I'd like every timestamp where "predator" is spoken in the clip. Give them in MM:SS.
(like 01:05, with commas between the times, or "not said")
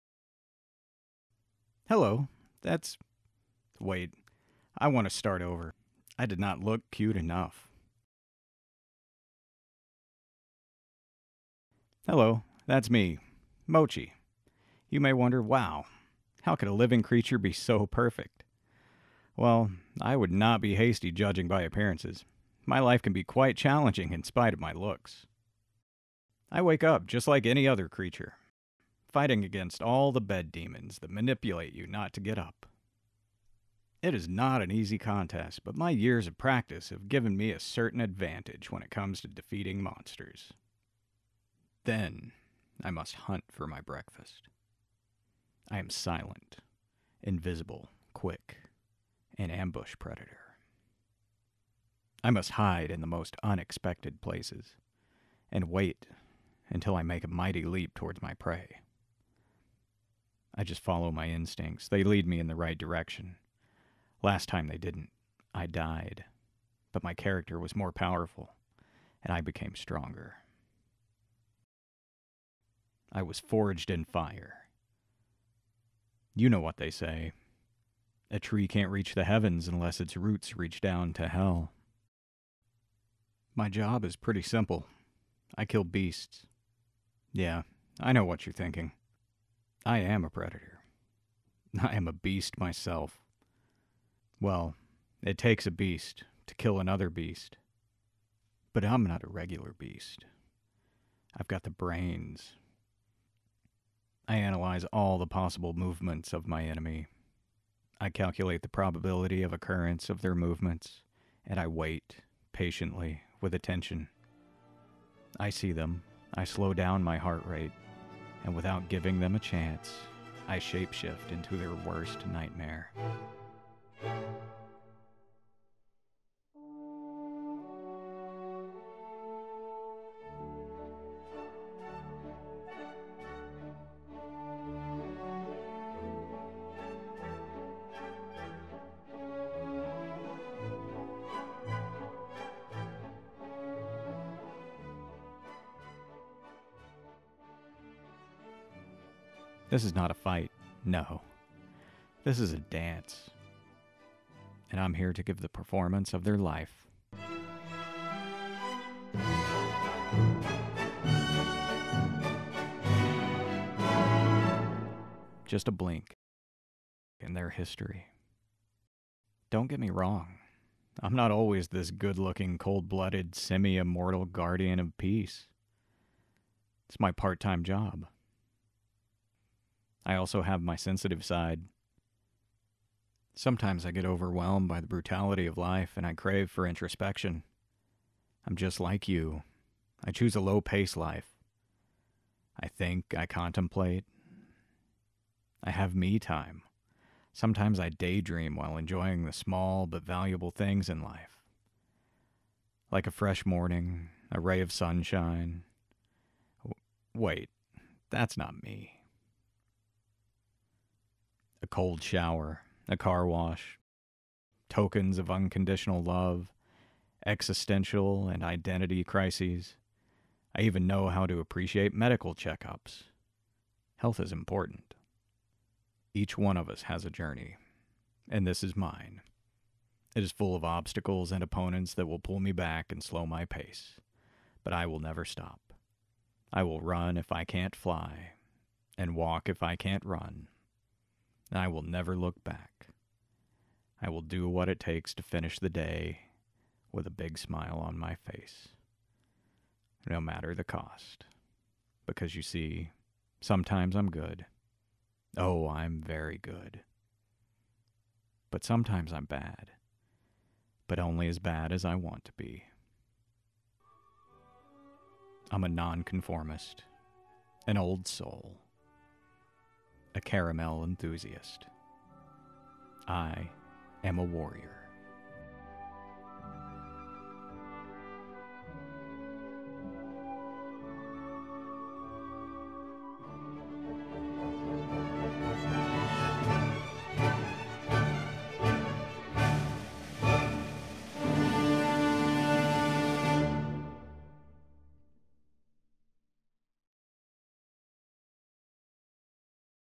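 00:49, 01:30.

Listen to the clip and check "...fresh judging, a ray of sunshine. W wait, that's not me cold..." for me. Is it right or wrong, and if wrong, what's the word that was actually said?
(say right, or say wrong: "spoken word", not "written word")
wrong: "morning", not "judging".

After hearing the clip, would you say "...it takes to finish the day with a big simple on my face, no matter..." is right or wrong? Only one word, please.
wrong.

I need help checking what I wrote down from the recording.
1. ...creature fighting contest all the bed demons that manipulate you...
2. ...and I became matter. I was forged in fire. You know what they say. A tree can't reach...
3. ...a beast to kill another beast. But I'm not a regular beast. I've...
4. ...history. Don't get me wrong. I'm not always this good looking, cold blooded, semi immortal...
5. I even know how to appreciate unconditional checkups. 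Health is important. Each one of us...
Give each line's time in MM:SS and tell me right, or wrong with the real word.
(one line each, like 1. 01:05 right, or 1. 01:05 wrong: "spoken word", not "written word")
1. 00:27 wrong: "against", not "contest"
2. 01:09 wrong: "stronger", not "matter"
3. 01:35 right
4. 02:47 right
5. 03:40 wrong: "medical", not "unconditional".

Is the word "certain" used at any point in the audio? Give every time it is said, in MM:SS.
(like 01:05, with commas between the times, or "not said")
00:37.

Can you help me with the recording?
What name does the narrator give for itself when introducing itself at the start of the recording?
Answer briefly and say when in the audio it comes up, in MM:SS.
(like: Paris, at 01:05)
Mochi, at 00:13.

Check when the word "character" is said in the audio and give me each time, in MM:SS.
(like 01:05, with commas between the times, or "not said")
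01:07.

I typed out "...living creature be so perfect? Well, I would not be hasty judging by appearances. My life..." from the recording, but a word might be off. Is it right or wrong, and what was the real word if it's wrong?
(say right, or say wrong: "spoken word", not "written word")
right.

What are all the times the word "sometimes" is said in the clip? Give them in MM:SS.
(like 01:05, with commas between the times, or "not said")
03:03, 03:17, 04:13, 04:18.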